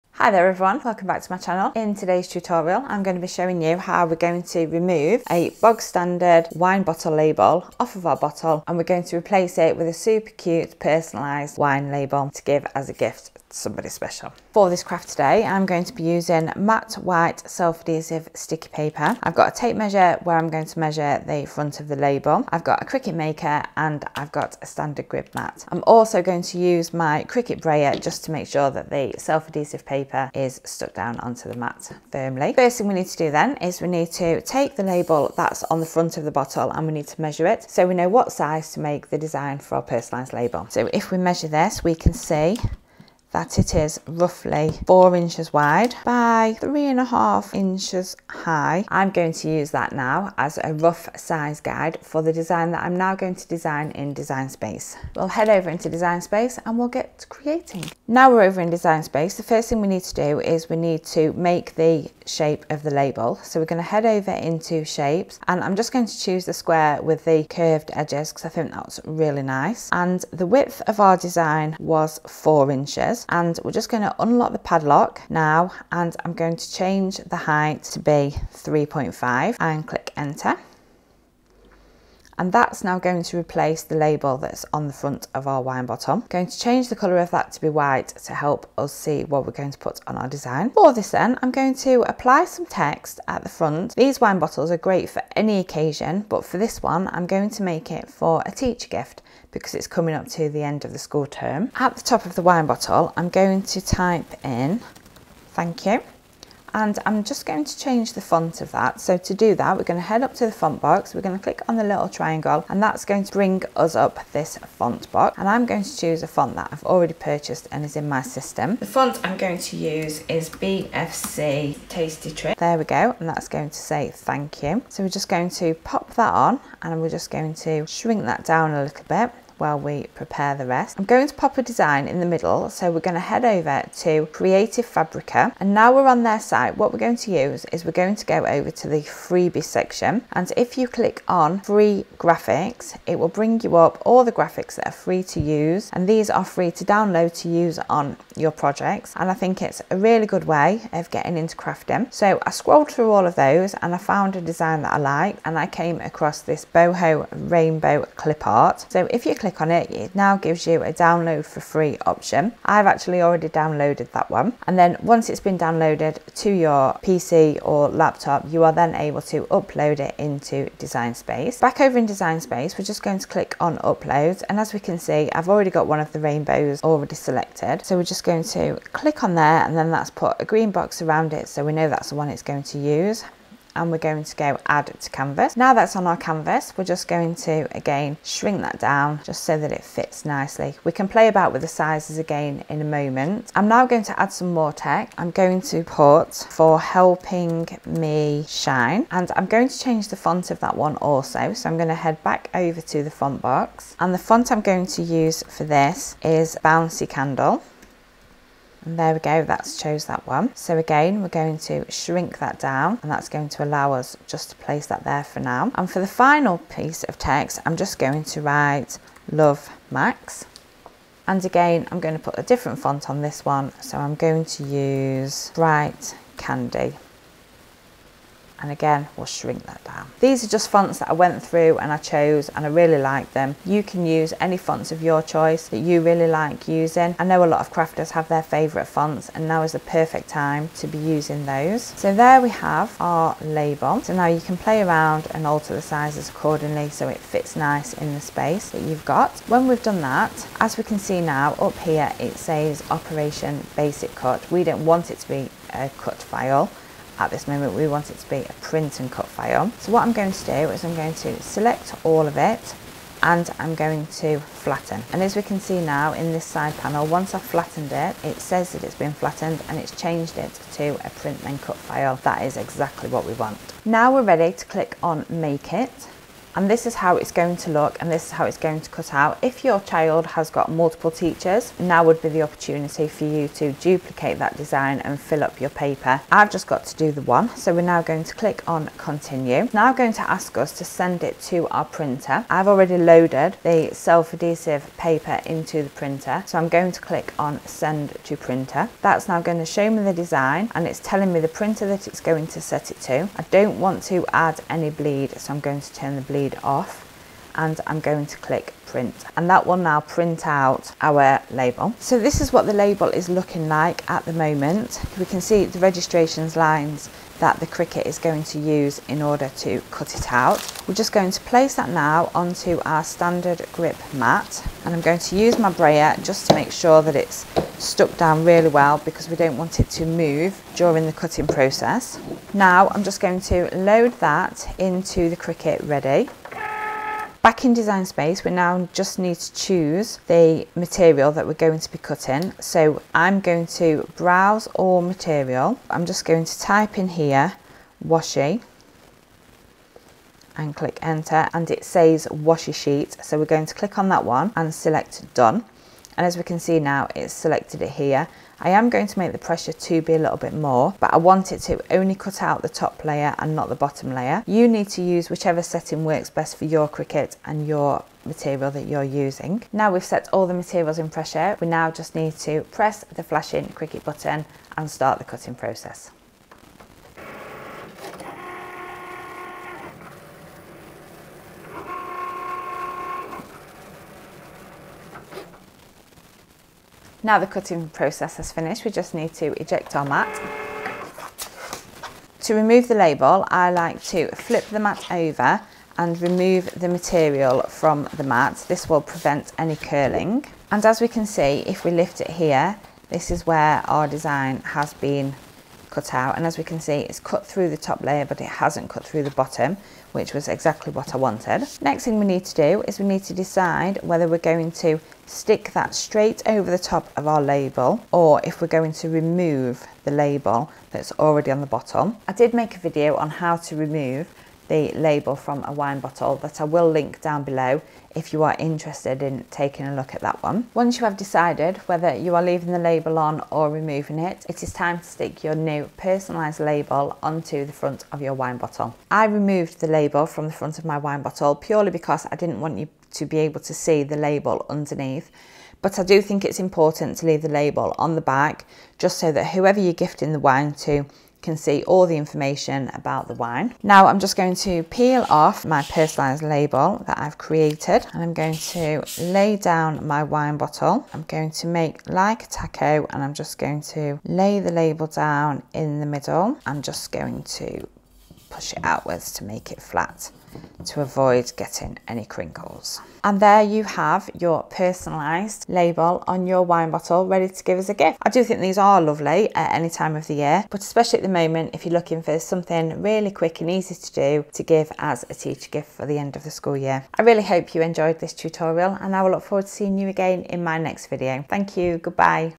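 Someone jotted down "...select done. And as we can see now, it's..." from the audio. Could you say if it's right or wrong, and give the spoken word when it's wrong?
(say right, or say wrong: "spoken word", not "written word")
right.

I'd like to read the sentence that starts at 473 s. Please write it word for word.
And there you have your personalised label on your wine bottle ready to give as a gift.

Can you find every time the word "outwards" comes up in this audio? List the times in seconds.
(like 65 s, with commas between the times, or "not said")
468 s.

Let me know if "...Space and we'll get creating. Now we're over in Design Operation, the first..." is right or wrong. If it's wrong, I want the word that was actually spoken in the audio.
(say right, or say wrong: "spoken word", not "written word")
wrong: "Space", not "Operation".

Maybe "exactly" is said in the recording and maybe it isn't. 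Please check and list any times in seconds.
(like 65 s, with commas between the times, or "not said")
272 s, 410 s.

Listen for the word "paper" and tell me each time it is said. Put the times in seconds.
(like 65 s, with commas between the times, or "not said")
18 s, 29 s, 285 s, 294 s.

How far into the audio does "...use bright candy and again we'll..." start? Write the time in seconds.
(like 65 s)
224 s.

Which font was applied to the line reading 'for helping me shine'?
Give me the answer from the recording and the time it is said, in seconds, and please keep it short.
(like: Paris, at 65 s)
Bouncy Candle, at 206 s.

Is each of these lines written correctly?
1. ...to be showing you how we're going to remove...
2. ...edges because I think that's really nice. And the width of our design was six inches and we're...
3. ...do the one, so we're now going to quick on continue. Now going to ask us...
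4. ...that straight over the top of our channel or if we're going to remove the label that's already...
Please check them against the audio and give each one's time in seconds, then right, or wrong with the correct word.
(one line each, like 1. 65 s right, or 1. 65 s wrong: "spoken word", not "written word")
1. 3 s right
2. 67 s wrong: "four", not "six"
3. 286 s wrong: "click", not "quick"
4. 415 s wrong: "label", not "channel".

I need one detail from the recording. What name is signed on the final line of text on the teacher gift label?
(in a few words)
Max.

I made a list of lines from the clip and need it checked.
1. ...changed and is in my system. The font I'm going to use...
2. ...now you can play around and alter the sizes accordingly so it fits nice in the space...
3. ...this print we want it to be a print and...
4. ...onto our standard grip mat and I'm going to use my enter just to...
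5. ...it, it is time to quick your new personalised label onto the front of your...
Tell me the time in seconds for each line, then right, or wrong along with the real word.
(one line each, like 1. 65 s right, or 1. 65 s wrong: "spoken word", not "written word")
1. 117 s wrong: "purchased", not "changed"
2. 244 s right
3. 257 s wrong: "moment", not "print"
4. 322 s wrong: "brayer", not "enter"
5. 434 s wrong: "stick", not "quick".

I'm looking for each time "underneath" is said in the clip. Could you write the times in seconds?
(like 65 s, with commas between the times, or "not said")
444 s.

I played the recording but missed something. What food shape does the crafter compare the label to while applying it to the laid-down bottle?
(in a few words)
Taco.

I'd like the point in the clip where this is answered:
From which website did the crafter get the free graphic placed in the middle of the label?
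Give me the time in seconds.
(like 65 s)
134 s.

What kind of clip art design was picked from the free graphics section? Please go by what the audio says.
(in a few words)
Boho rainbow.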